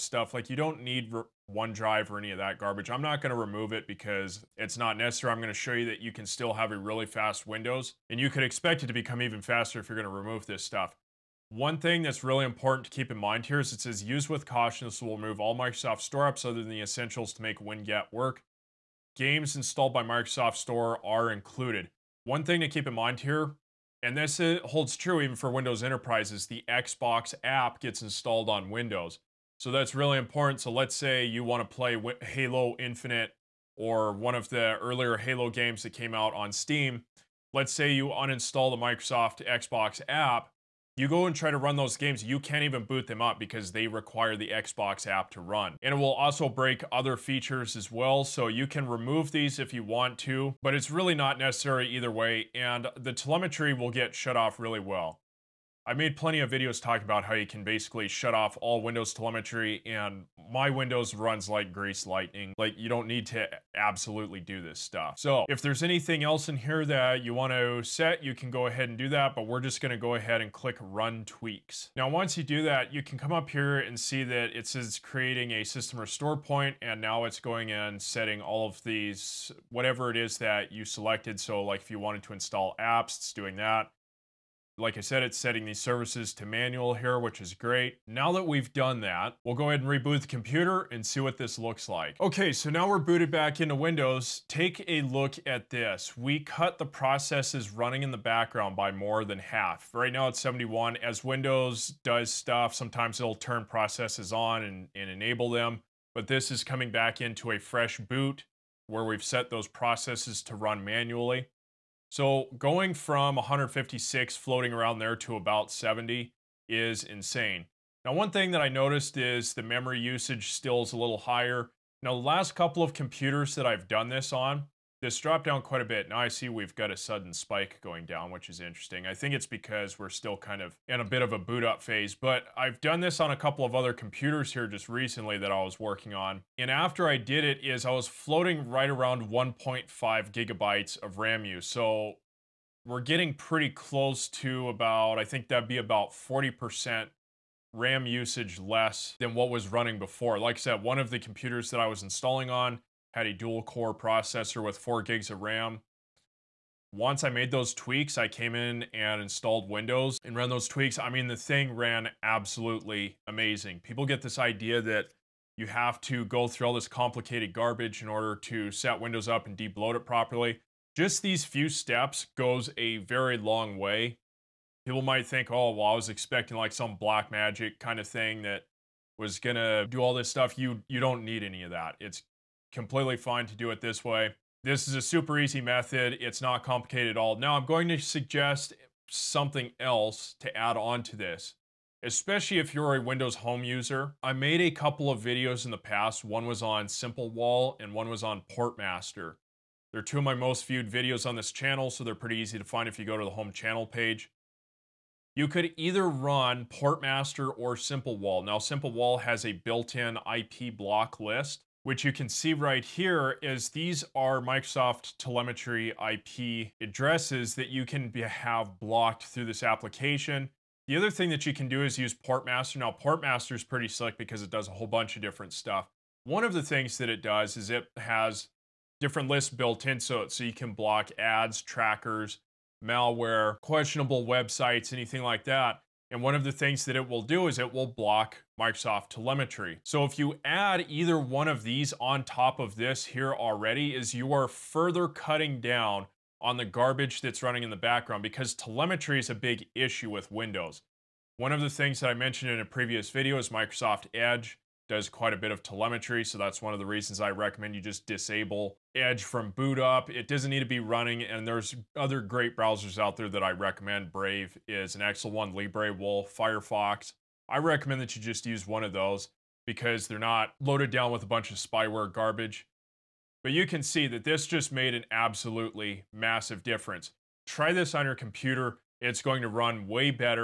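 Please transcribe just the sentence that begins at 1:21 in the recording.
So like if you wanted to install apps, it's doing that.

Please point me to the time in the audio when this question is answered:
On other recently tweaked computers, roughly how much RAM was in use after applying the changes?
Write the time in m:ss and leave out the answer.
2:19.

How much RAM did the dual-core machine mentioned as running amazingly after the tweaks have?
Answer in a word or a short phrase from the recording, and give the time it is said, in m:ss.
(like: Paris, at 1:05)
4 gigs, at 2:34.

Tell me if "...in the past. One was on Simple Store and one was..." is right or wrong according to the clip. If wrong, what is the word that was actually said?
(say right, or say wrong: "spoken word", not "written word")
wrong: "Wall", not "Store".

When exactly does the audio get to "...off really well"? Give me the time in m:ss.
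0:54.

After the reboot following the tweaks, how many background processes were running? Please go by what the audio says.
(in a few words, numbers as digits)
71.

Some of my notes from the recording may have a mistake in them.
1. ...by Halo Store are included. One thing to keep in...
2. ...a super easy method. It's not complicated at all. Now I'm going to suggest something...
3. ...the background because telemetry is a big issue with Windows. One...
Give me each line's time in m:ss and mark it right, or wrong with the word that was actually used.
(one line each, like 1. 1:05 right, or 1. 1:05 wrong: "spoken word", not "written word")
1. 0:19 wrong: "Microsoft", not "Halo"
2. 3:04 right
3. 4:07 right.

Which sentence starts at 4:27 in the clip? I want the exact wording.
I recommend that you just use one of those because they're not loaded down with a bunch of spyware garbage.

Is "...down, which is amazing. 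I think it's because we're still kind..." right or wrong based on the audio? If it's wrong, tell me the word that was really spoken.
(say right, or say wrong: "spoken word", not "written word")
wrong: "interesting", not "amazing".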